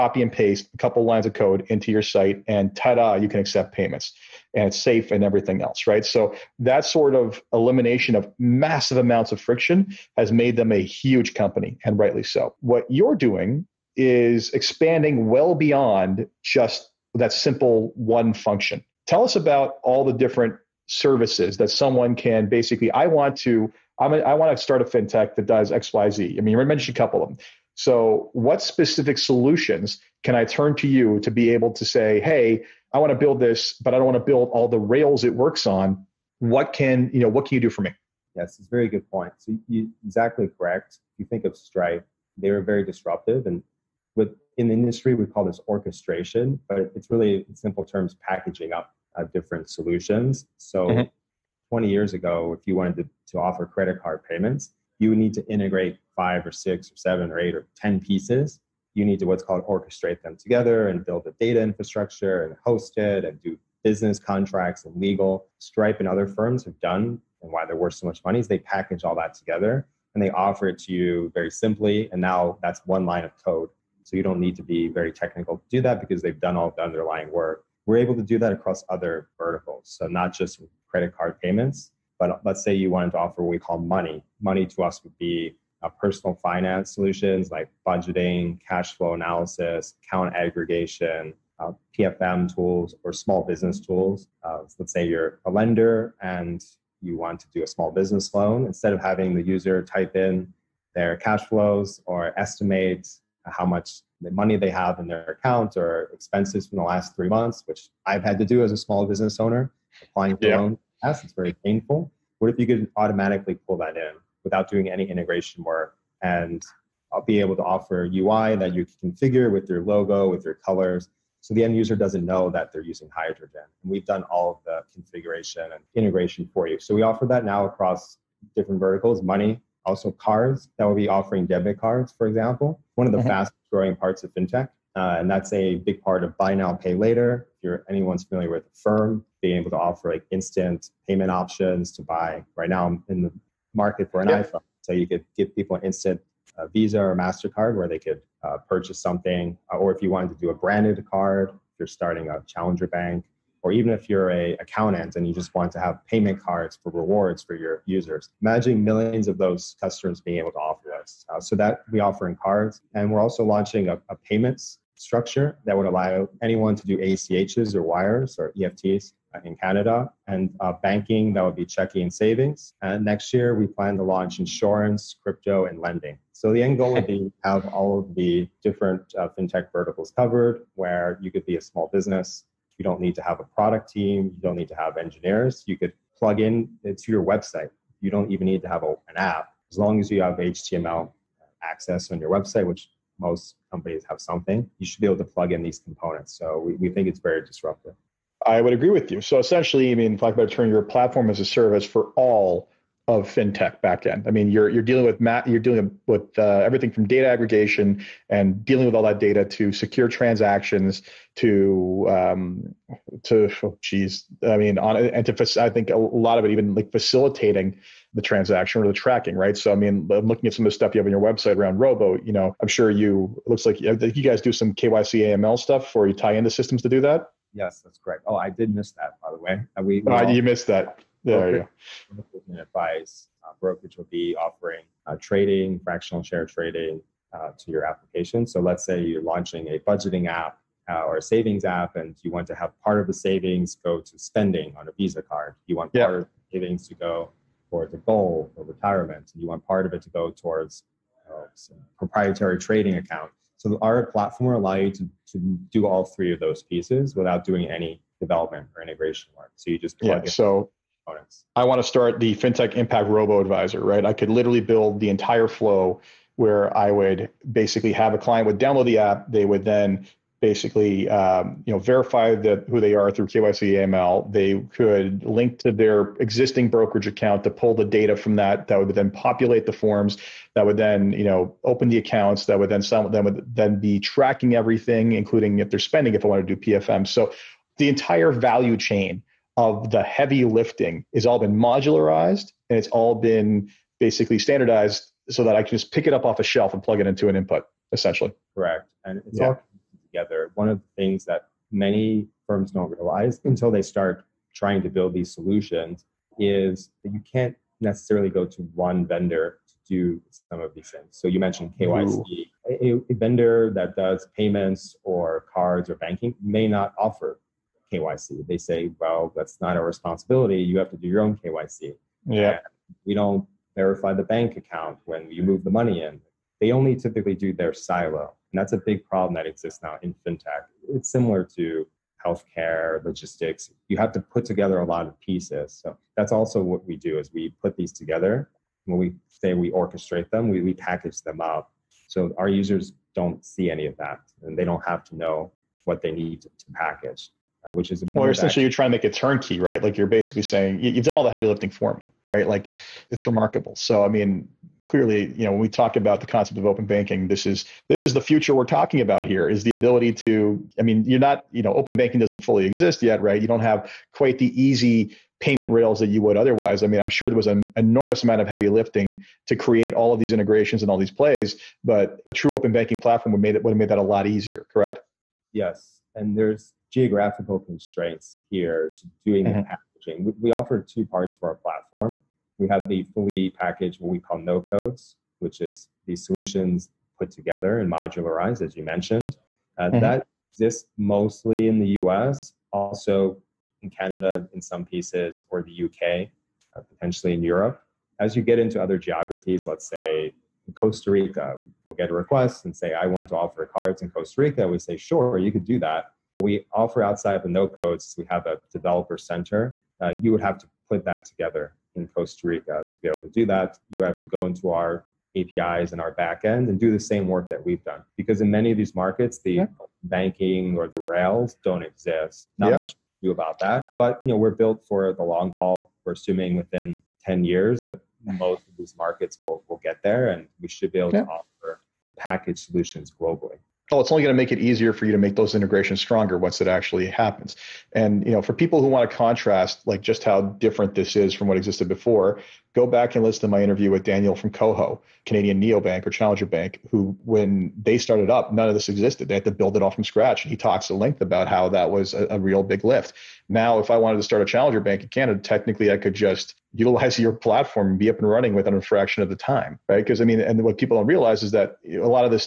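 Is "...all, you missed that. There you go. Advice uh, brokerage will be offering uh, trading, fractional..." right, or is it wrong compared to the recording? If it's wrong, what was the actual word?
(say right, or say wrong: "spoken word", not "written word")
right.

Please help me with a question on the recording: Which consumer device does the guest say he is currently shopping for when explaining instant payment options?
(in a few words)
iPhone.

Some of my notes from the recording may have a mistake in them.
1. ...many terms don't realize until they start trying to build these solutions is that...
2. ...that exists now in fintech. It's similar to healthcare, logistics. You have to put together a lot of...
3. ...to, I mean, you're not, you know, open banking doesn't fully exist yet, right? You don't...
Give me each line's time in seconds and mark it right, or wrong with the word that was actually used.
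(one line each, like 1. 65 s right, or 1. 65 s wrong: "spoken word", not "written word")
1. 301 s wrong: "firms", not "terms"
2. 329 s right
3. 360 s right.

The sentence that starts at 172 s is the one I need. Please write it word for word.
And next year, we plan to launch insurance, crypto, and lending.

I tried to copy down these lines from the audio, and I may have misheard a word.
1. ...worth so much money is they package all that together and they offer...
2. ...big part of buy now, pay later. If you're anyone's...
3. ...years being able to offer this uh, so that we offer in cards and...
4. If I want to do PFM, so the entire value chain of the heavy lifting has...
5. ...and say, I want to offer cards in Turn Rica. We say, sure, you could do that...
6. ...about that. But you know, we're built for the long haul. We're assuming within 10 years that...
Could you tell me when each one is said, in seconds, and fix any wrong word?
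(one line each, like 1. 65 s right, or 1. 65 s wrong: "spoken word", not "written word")
1. 67 s right
2. 135 s right
3. 159 s wrong: "customers", not "years"
4. 286 s right
5. 402 s wrong: "Costa", not "Turn"
6. 423 s right.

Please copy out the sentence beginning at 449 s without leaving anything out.
They had to build it all from scratch.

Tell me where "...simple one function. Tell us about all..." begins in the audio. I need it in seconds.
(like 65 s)
17 s.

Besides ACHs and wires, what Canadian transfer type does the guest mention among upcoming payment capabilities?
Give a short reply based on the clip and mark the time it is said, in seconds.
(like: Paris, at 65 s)
EFTs, at 168 s.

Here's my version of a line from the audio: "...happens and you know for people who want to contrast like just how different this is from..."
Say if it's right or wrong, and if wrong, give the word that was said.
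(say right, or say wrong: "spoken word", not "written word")
right.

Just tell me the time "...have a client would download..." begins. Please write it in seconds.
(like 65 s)
267 s.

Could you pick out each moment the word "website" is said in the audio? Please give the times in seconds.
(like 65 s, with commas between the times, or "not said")
187 s, 192 s, 221 s.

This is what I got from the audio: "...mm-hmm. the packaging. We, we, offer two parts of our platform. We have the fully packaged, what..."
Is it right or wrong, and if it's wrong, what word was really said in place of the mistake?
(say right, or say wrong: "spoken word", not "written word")
right.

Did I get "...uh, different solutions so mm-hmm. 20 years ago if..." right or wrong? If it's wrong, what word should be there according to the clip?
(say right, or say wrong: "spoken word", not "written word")
right.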